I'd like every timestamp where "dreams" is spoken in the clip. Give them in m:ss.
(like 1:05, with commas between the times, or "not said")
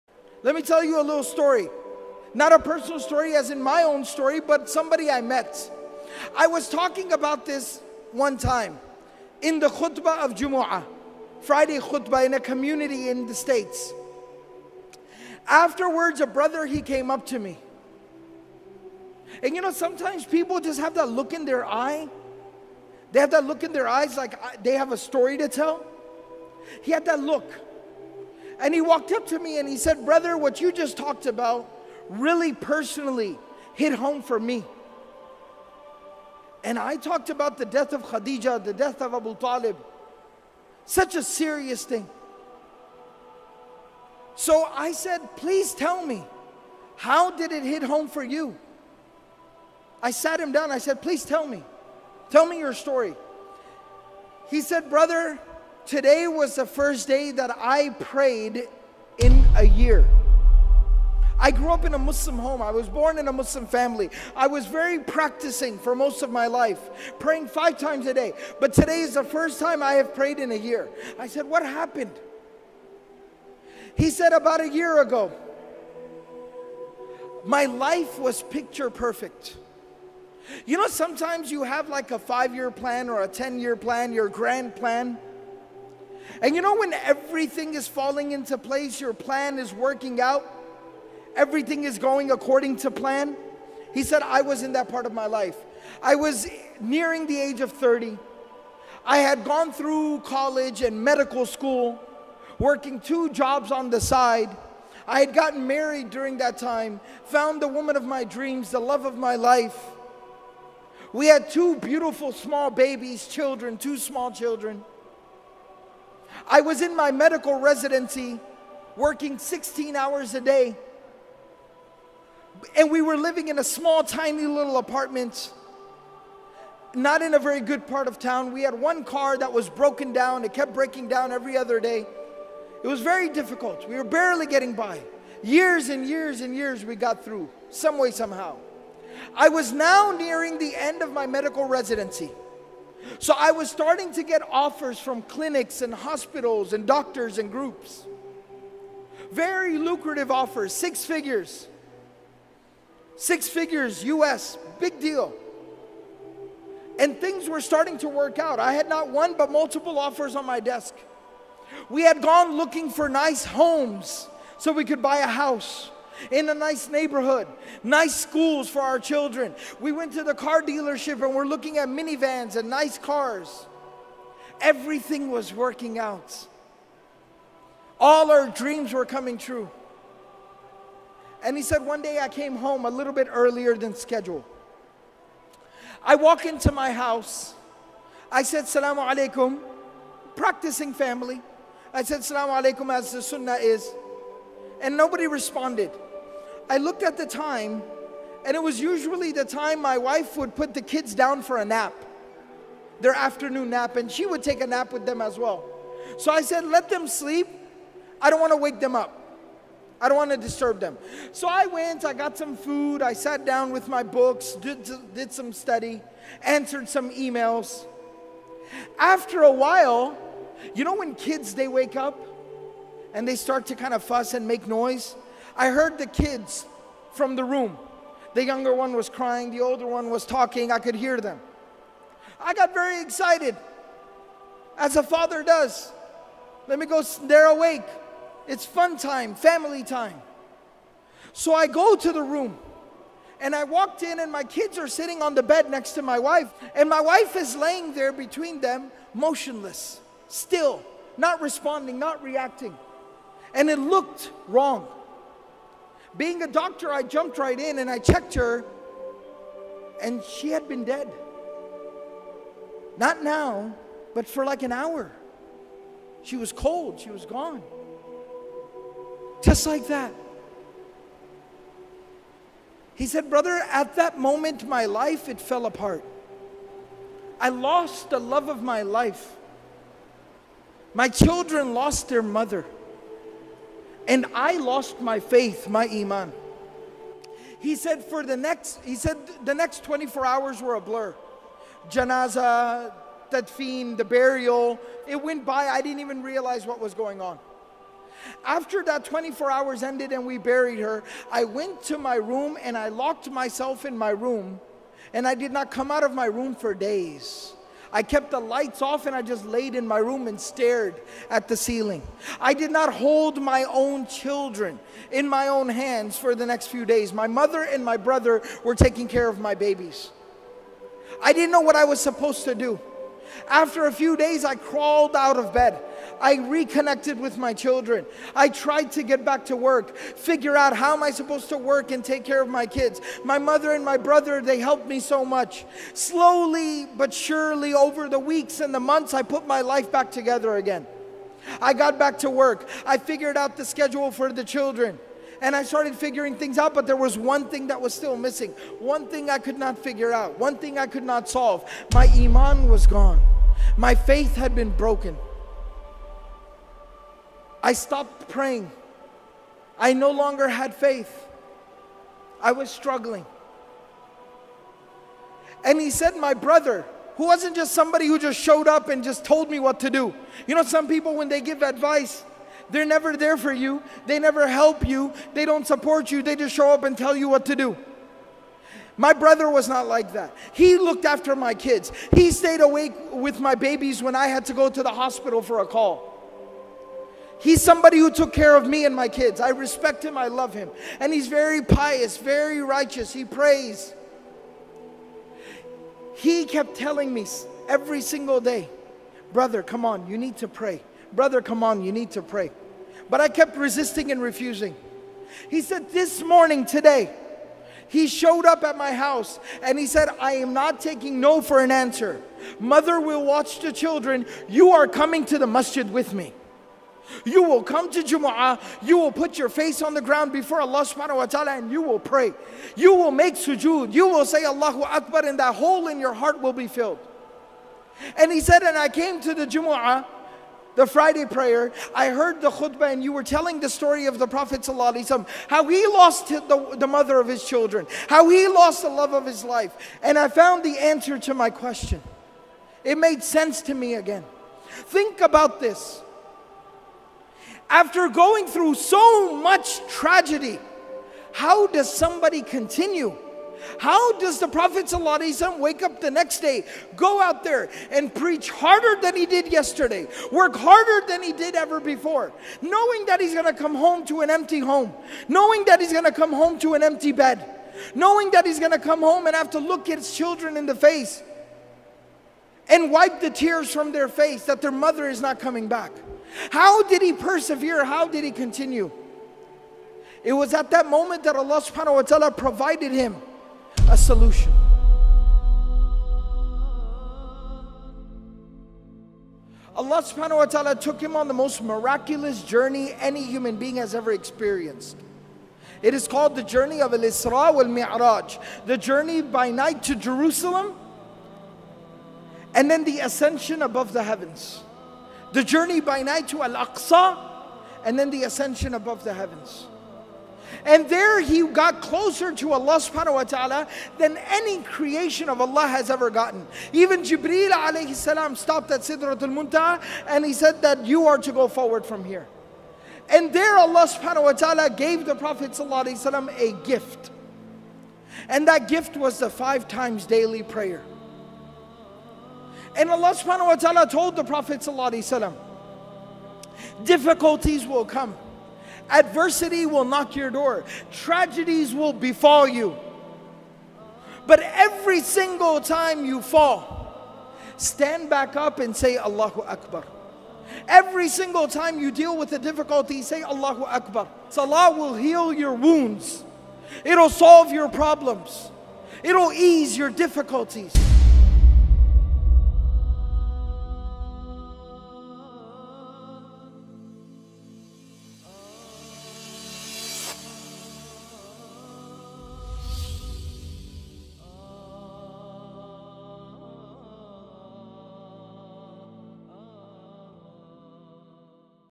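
1:48, 2:58.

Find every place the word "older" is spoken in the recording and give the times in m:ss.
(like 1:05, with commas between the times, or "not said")
3:49.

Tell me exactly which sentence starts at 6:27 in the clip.
He's somebody who took care of me and my kids.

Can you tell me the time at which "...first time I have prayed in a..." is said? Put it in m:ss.
1:09.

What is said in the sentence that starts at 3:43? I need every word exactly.
and they start to kind of fuss and make noise.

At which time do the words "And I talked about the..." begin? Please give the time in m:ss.
0:36.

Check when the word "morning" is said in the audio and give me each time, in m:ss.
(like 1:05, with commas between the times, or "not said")
6:46.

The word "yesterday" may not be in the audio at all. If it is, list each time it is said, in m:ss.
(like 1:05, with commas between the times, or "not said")
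7:39.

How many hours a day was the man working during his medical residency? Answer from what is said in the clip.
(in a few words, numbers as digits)
16.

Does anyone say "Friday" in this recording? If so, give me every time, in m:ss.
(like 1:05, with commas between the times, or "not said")
0:11, 7:10.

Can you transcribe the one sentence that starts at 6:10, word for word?
You know, some people, when they give advice, they're never there for you.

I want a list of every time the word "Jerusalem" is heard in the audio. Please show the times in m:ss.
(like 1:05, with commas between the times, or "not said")
8:19.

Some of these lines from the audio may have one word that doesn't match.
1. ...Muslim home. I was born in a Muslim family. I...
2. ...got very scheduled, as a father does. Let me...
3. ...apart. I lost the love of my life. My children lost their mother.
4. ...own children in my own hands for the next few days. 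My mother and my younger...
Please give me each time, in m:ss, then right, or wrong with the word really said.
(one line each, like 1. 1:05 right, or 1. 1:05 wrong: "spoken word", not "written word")
1. 1:01 right
2. 3:52 wrong: "excited", not "scheduled"
3. 4:35 right
4. 5:13 wrong: "brother", not "younger".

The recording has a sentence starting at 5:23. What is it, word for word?
After a few days, I crawled out of bed.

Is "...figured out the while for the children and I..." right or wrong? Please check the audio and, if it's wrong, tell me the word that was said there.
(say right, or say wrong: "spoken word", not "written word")
wrong: "schedule", not "while".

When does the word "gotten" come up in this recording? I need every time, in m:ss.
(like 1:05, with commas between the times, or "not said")
1:45, 8:36.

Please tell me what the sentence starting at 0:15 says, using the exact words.
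Afterwards, a brother, he came up to me.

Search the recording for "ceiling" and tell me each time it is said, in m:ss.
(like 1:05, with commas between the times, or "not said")
5:11.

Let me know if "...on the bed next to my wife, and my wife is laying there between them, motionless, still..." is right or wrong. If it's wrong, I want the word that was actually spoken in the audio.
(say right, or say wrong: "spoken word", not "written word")
right.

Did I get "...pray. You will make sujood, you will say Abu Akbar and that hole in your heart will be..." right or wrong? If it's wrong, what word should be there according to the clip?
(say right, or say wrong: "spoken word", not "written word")
wrong: "Allahu", not "Abu".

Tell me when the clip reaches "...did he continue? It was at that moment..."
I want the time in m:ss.
7:58.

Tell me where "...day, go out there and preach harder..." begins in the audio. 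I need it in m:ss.
7:36.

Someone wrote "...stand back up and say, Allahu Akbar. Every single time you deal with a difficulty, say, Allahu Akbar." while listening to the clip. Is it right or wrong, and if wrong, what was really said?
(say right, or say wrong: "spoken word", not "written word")
right.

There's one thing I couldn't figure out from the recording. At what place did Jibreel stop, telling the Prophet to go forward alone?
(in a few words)
Sidratul Muntaha.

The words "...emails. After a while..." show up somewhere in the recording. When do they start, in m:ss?
3:37.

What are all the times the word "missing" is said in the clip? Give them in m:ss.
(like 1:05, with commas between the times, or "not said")
5:48.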